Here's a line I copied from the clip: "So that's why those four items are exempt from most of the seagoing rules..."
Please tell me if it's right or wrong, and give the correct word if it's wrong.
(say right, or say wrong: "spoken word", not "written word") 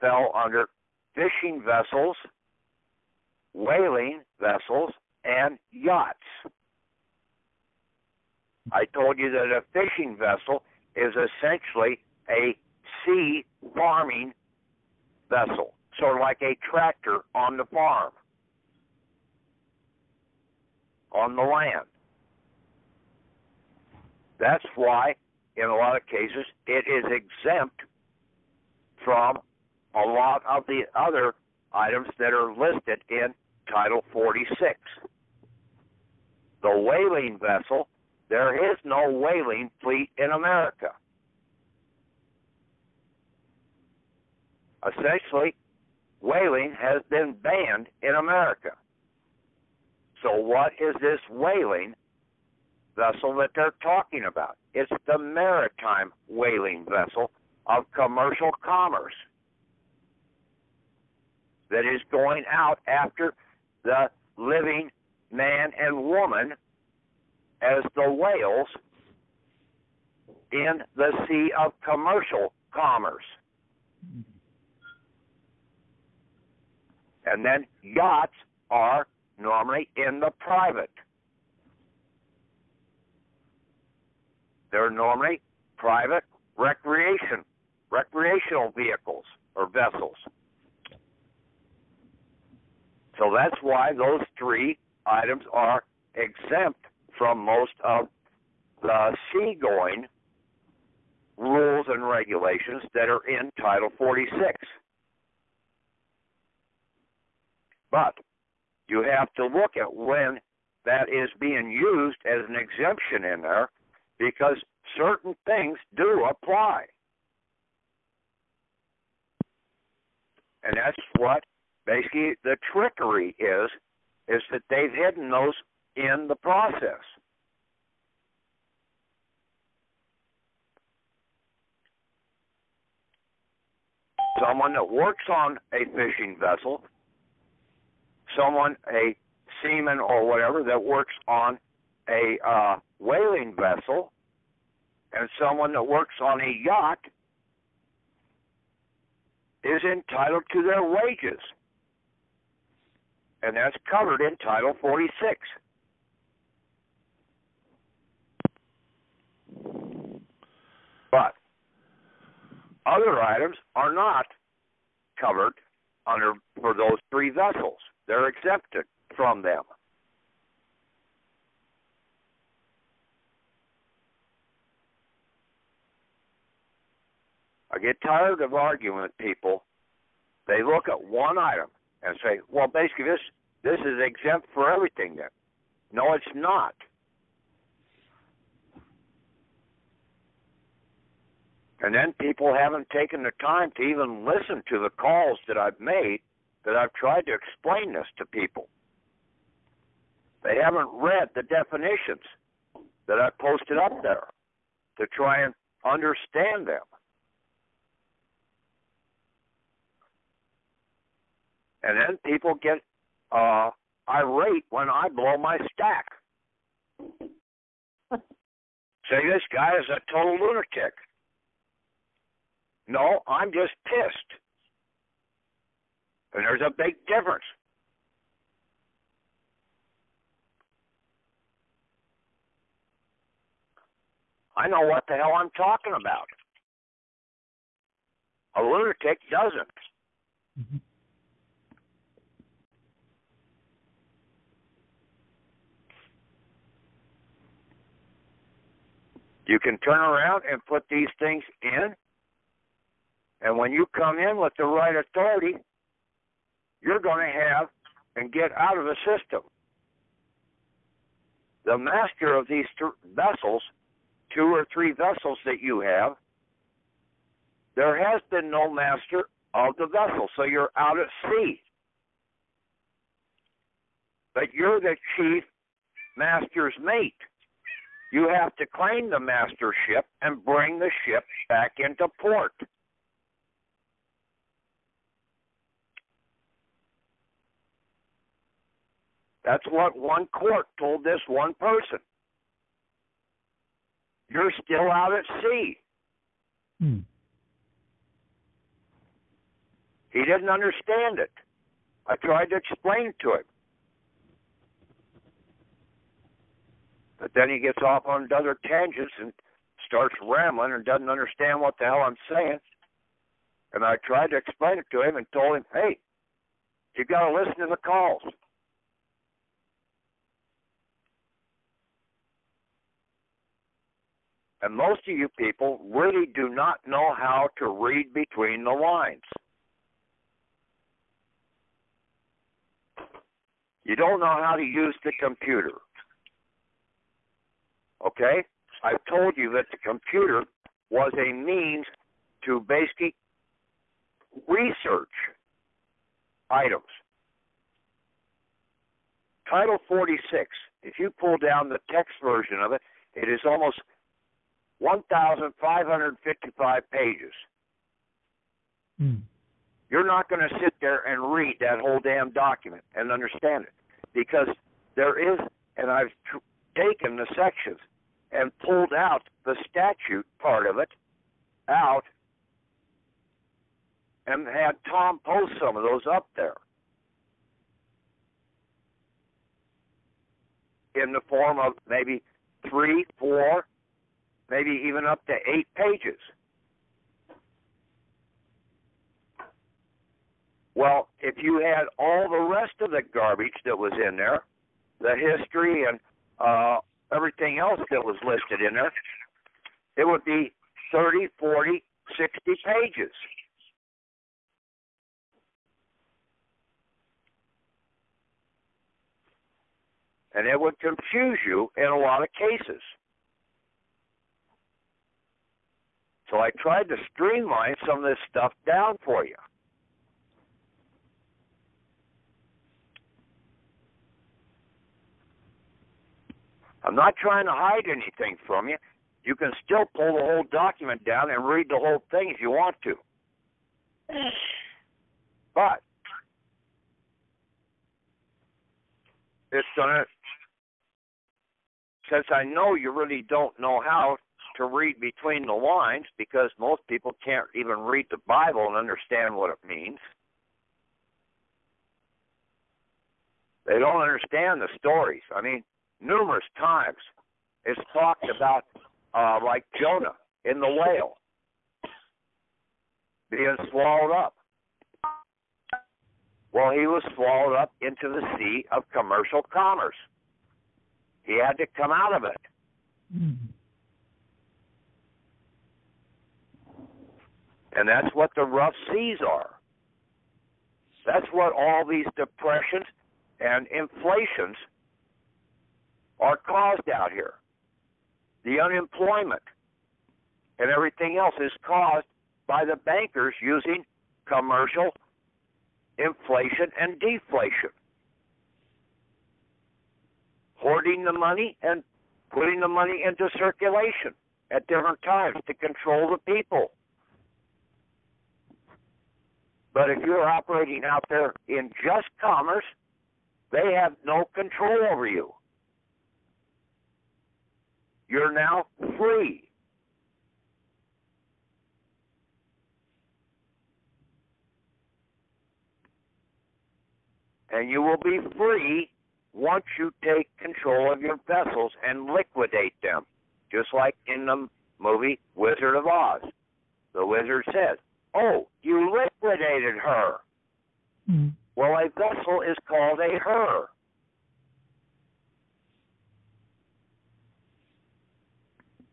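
wrong: "three", not "four".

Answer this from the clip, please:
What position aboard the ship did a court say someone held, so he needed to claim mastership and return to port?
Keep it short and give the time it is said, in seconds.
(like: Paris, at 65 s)
Chief master's mate, at 275 s.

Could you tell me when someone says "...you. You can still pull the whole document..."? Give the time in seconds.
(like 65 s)
428 s.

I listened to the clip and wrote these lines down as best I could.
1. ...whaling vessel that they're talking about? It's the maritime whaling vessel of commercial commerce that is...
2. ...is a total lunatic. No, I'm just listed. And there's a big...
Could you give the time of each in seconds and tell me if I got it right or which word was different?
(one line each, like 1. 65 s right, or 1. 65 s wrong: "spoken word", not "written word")
1. 51 s right
2. 219 s wrong: "pissed", not "listed".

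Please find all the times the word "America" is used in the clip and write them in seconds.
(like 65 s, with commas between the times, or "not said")
40 s, 48 s.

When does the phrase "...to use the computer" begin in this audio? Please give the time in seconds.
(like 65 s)
334 s.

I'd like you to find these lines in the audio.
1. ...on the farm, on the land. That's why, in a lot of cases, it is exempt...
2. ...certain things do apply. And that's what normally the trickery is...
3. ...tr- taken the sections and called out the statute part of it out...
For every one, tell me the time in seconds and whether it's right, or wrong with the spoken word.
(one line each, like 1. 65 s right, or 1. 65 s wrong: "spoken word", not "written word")
1. 17 s right
2. 114 s wrong: "basically", not "normally"
3. 366 s wrong: "pulled", not "called".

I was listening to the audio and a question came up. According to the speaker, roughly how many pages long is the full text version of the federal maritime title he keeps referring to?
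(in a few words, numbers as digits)
1,555.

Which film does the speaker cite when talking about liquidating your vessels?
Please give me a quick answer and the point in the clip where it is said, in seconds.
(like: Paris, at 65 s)
Wizard of Oz, at 535 s.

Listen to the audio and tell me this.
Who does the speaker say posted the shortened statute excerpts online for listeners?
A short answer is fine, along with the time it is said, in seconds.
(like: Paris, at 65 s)
Tom, at 374 s.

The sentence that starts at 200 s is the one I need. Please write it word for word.
They haven't read the definitions that I posted up there to try and understand them.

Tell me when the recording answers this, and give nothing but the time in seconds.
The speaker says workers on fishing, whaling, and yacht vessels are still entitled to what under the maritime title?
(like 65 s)
150 s.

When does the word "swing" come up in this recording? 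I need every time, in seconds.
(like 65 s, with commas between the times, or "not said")
not said.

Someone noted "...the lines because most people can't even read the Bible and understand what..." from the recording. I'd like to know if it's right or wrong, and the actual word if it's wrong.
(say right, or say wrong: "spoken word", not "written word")
right.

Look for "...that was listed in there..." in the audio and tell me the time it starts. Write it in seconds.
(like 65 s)
397 s.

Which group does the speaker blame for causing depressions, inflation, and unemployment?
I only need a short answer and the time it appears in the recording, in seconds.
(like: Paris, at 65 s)
The bankers, at 492 s.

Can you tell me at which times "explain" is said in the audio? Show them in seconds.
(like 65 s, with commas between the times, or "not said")
197 s, 302 s, 314 s.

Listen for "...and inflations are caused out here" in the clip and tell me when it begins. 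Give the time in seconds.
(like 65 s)
483 s.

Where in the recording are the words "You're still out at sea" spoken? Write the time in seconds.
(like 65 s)
294 s.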